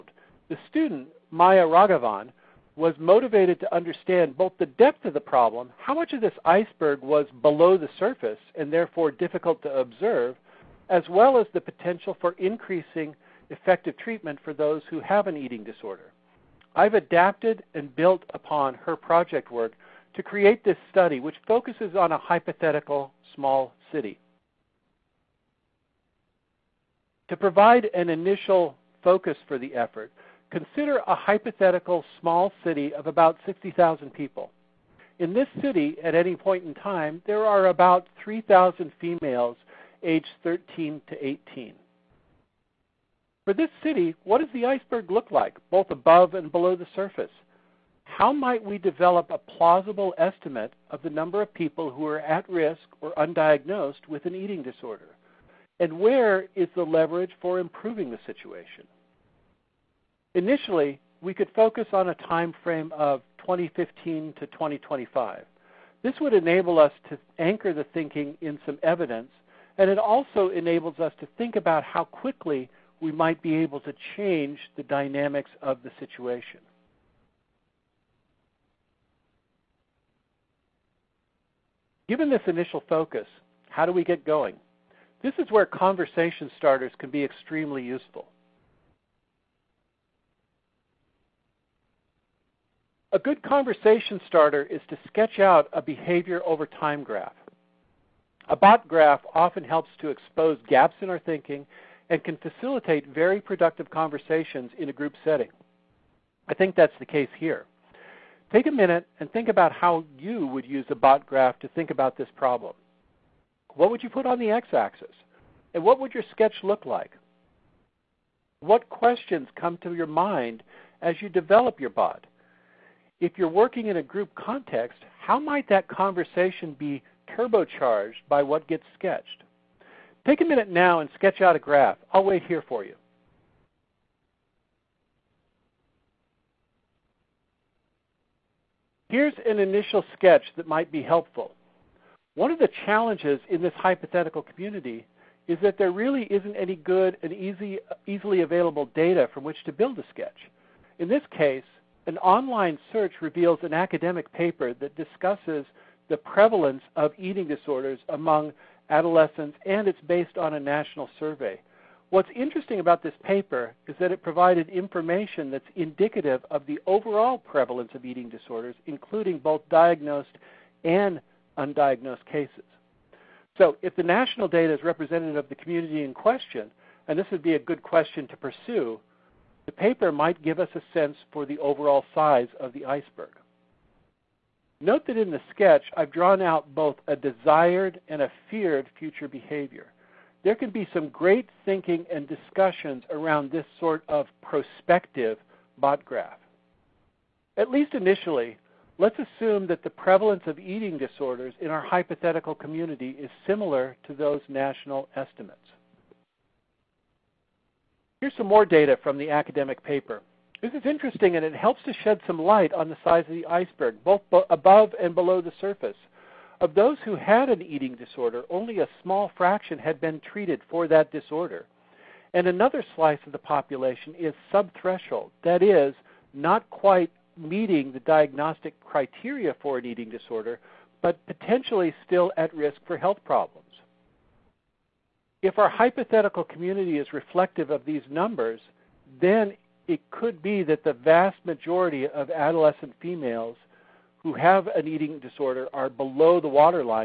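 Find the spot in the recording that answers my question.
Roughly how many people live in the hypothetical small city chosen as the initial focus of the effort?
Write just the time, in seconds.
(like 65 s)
33 s.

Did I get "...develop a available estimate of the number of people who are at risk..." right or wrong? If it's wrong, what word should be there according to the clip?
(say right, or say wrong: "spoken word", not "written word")
wrong: "plausible", not "available".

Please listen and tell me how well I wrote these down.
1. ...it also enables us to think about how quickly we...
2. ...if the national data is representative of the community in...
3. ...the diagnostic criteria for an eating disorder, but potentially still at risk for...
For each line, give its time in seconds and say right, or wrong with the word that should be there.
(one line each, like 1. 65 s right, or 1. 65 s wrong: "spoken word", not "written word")
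1. 69 s right
2. 173 s right
3. 227 s right.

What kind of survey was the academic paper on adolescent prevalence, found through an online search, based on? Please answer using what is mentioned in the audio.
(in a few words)
national survey.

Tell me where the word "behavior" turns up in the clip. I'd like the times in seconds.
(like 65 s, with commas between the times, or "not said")
95 s, 189 s.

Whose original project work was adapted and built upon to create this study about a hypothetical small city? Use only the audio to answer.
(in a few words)
Maya Ragavan.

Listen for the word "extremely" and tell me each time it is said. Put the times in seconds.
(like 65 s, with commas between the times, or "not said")
87 s.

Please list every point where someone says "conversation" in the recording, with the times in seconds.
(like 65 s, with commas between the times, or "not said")
85 s, 93 s, 103 s, 125 s.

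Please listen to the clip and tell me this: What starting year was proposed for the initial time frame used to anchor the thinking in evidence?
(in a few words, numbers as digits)
2015.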